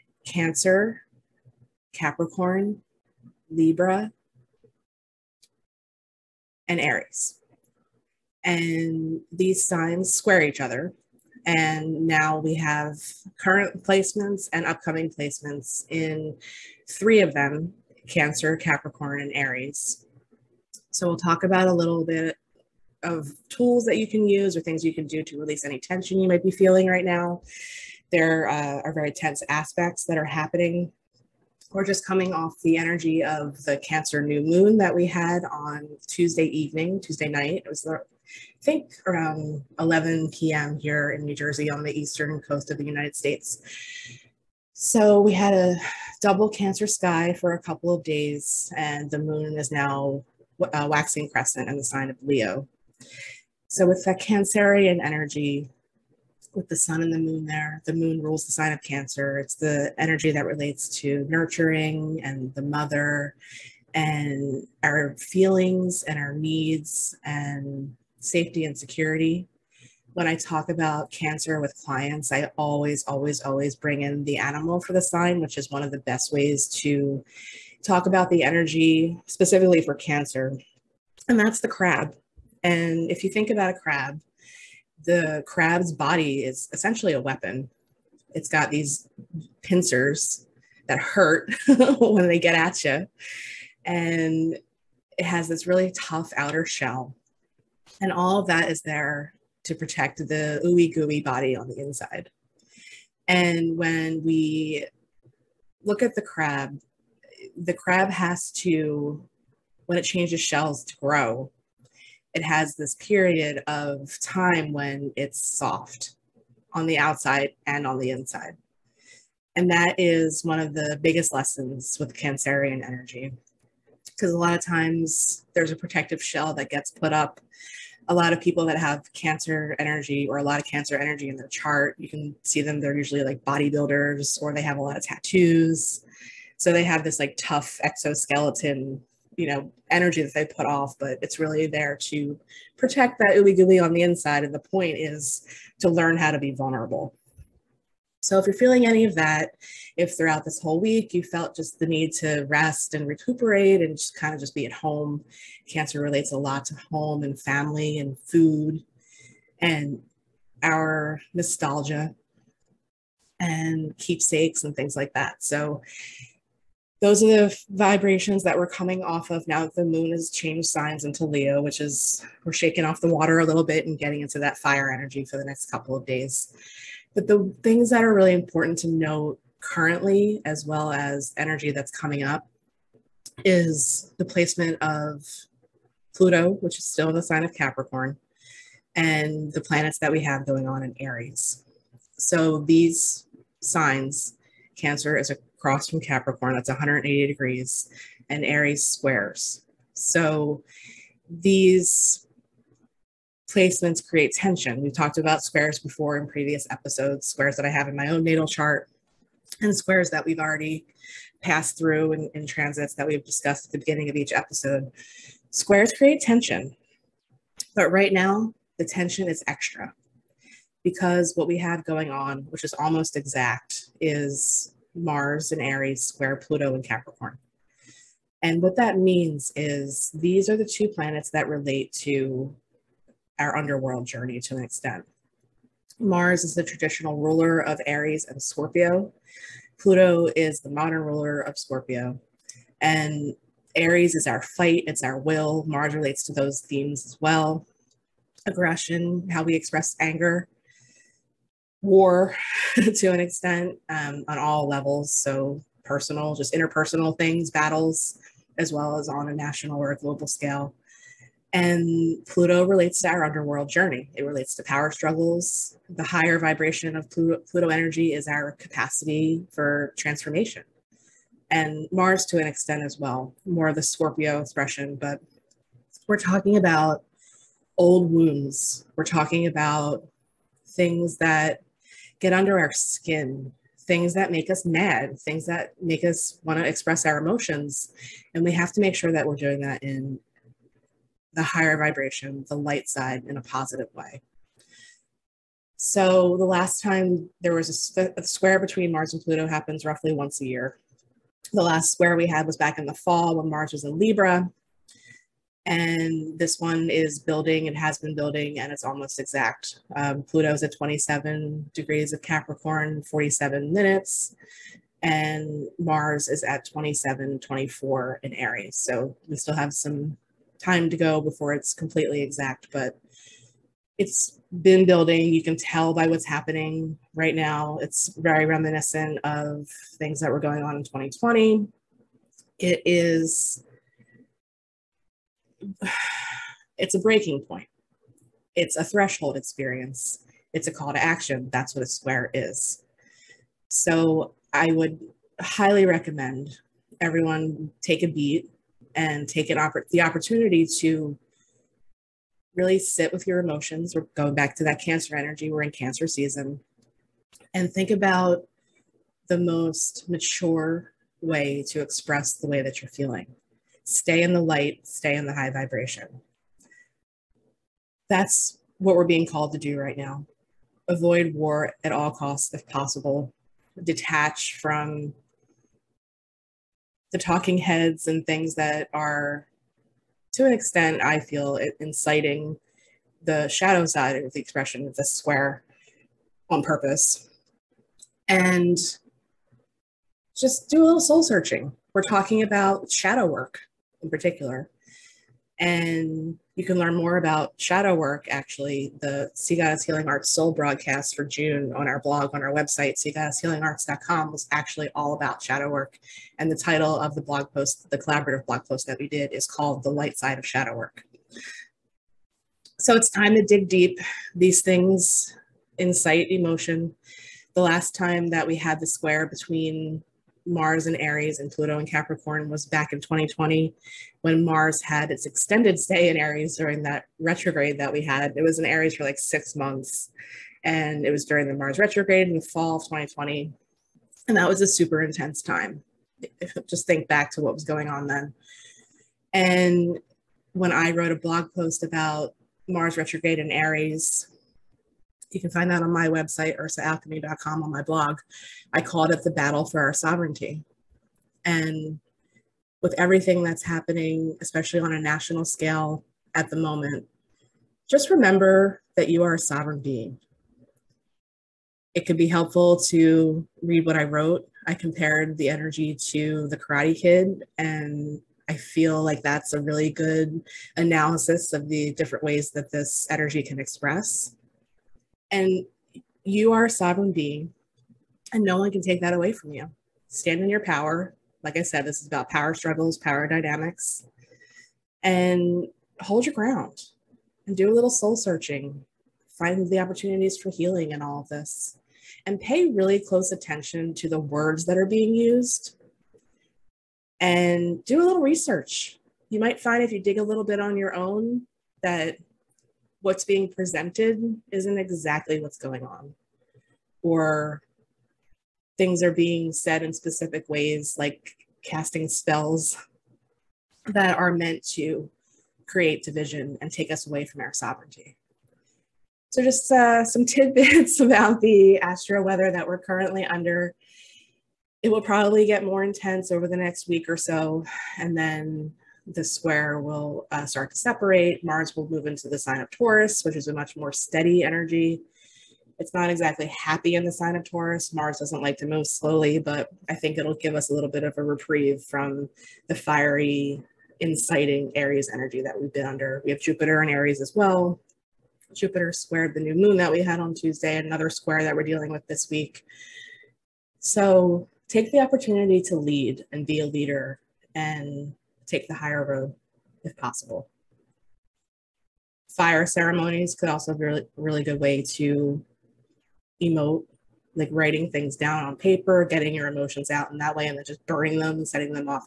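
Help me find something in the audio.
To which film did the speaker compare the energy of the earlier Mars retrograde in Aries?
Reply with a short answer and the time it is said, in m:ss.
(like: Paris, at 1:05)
The Karate Kid, at 7:46.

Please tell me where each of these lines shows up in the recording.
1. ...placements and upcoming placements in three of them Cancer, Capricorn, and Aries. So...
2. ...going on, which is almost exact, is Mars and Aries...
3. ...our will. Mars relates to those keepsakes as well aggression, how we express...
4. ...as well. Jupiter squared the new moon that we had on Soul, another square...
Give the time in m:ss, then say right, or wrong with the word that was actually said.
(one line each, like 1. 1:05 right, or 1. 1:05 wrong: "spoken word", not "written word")
1. 0:13 right
2. 3:41 right
3. 4:05 wrong: "themes", not "keepsakes"
4. 9:07 wrong: "Tuesday", not "Soul".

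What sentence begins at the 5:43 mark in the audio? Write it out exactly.
So I would highly recommend everyone take a beat and take an oppor- the opportunity to really sit with your emotions.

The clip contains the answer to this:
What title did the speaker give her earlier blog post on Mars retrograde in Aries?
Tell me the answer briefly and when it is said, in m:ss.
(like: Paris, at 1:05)
the battle for our sovereignty, at 7:29.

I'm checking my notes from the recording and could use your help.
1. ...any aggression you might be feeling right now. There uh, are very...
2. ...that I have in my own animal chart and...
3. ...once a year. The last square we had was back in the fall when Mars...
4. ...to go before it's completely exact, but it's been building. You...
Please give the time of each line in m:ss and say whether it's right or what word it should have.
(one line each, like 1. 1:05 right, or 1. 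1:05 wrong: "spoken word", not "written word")
1. 0:25 wrong: "tension", not "aggression"
2. 3:27 wrong: "natal", not "animal"
3. 5:00 right
4. 5:20 right.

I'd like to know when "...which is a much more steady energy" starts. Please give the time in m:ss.
8:53.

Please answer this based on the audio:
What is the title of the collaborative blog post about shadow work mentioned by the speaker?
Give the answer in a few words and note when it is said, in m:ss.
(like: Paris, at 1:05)
The Light Side of Shadow Work, at 6:49.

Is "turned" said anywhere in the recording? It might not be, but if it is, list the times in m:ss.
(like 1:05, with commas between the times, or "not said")
not said.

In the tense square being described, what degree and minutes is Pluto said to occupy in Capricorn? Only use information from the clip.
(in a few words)
27 degrees 47 minutes.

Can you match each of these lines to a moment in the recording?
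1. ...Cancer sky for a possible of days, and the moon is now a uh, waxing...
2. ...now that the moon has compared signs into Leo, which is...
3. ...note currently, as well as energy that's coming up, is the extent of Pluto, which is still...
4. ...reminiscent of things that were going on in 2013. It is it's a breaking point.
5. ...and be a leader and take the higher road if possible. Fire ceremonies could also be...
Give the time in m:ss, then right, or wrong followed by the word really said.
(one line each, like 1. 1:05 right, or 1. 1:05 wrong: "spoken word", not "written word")
1. 0:46 wrong: "couple", not "possible"
2. 2:49 wrong: "changed", not "compared"
3. 2:58 wrong: "placement", not "extent"
4. 5:28 wrong: "2020", not "2013"
5. 9:16 right.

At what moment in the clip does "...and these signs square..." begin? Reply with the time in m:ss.
0:08.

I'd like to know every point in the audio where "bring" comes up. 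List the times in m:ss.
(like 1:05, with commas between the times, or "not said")
1:13.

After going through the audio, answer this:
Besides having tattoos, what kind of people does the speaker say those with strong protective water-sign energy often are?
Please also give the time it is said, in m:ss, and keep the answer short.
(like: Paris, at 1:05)
bodybuilders, at 2:13.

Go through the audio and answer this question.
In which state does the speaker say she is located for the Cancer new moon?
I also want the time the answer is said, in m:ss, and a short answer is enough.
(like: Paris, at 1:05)
New Jersey, at 0:41.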